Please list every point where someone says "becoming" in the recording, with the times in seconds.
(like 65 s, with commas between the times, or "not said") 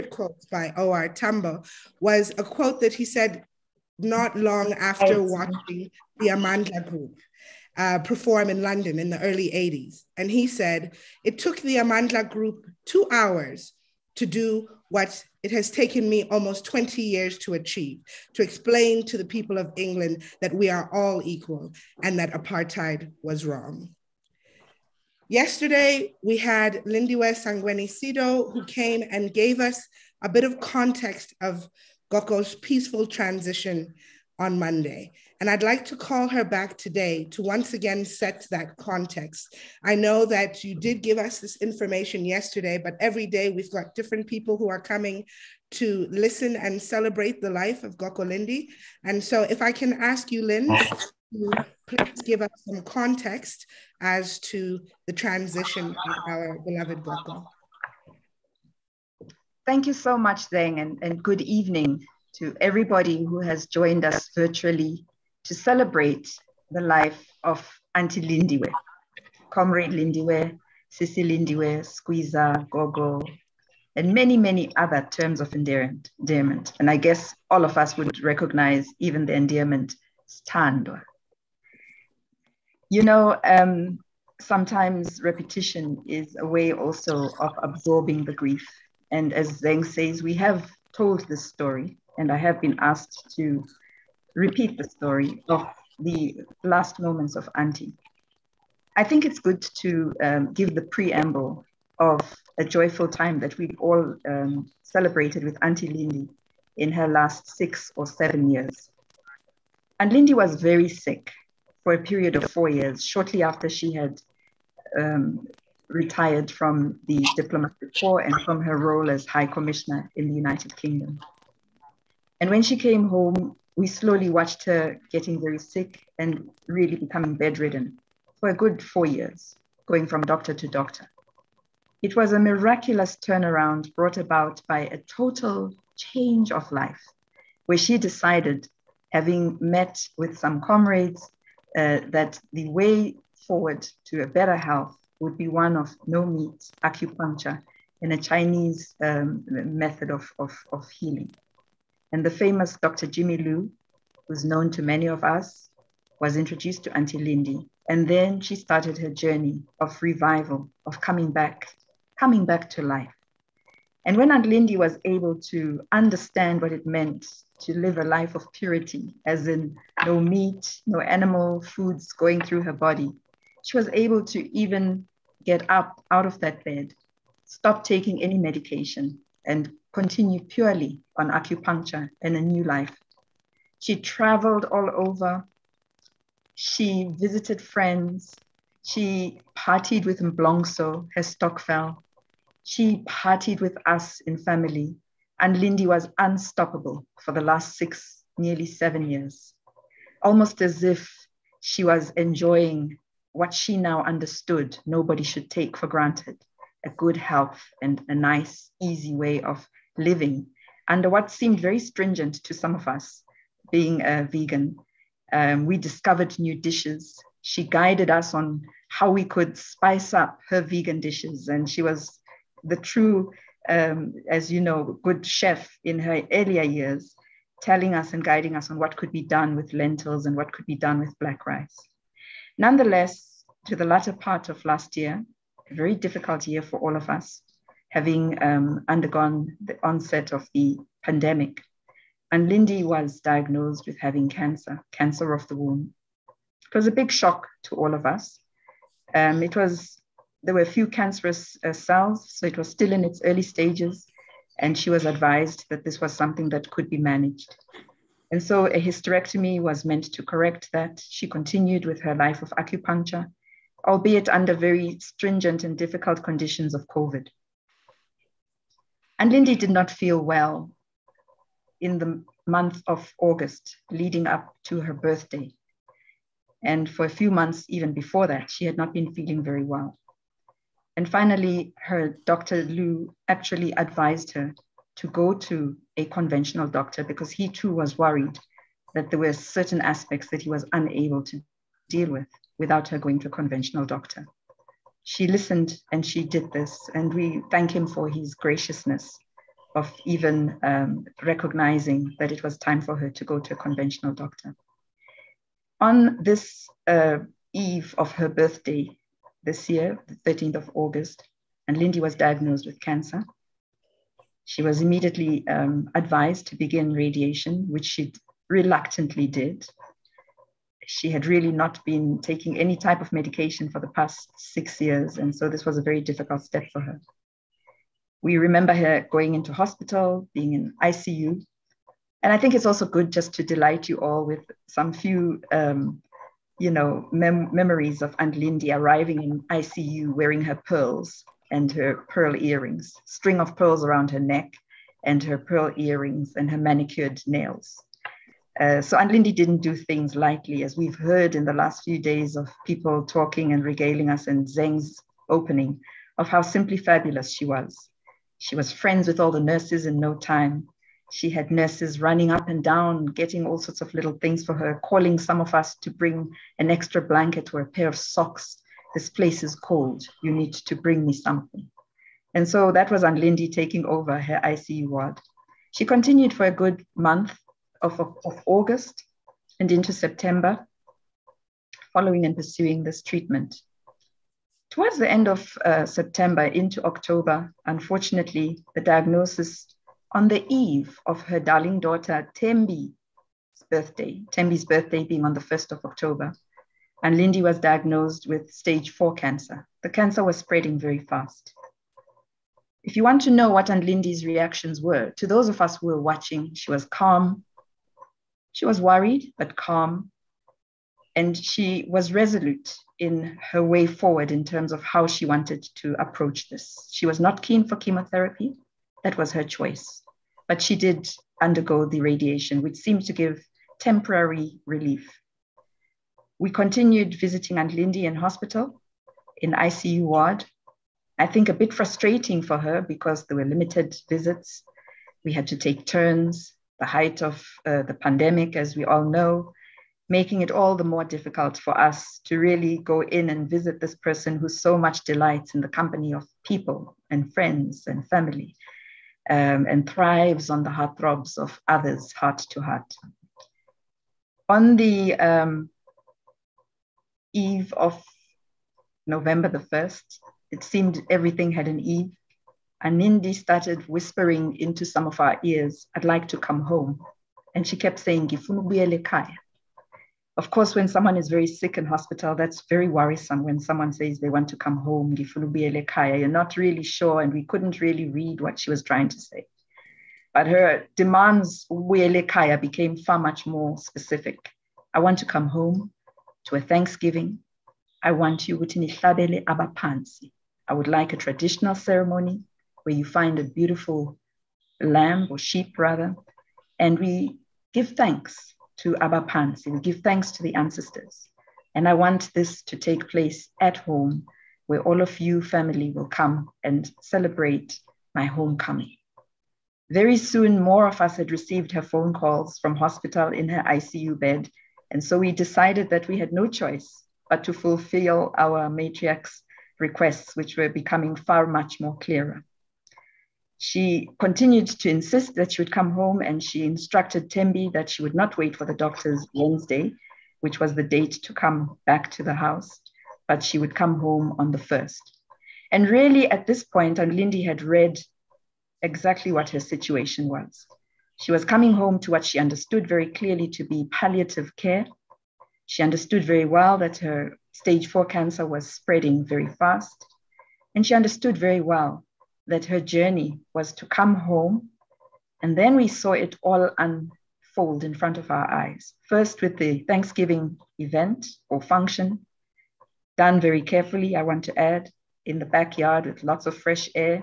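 126 s, 520 s.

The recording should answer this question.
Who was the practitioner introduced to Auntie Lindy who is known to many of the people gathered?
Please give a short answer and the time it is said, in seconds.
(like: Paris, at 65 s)
Dr. Jimmy Liu, at 152 s.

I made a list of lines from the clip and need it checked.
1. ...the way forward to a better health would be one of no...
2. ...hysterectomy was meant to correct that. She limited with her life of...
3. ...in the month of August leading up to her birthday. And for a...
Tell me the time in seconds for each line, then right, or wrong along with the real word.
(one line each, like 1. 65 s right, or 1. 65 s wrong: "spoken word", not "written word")
1. 142 s right
2. 258 s wrong: "continued", not "limited"
3. 271 s right.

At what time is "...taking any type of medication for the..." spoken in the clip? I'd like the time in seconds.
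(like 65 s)
322 s.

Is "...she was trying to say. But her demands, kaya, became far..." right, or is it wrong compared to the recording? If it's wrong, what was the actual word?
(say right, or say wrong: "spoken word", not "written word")
right.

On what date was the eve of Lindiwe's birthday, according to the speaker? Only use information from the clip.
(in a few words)
13 August.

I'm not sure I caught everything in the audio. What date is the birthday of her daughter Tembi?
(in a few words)
1 October.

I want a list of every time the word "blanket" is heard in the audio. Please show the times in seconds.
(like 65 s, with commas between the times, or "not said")
367 s.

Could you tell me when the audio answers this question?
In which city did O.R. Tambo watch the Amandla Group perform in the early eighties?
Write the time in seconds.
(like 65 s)
8 s.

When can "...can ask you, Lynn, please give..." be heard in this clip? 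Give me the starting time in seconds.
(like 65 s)
49 s.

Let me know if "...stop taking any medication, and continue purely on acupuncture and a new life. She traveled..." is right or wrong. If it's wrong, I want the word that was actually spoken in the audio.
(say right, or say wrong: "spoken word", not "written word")
right.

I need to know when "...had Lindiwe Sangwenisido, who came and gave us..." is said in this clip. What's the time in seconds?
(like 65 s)
26 s.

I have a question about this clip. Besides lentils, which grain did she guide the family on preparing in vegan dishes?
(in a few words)
black rice.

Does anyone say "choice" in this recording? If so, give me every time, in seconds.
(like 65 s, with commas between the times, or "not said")
419 s, 516 s.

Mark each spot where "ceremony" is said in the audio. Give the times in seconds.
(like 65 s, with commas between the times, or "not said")
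491 s.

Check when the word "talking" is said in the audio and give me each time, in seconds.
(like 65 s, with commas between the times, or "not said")
353 s.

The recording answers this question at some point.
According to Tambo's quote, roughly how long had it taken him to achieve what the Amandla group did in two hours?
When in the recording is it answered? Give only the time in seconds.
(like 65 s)
16 s.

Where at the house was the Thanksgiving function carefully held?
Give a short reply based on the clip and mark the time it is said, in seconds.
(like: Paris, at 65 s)
the backyard, at 565 s.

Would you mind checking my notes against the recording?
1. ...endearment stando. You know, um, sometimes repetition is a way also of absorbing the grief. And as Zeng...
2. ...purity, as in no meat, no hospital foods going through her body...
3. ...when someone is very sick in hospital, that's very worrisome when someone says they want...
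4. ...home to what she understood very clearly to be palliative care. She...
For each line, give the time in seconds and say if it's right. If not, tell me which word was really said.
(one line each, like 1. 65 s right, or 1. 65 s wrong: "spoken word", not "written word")
1. 79 s right
2. 168 s wrong: "animal", not "hospital"
3. 470 s right
4. 541 s right.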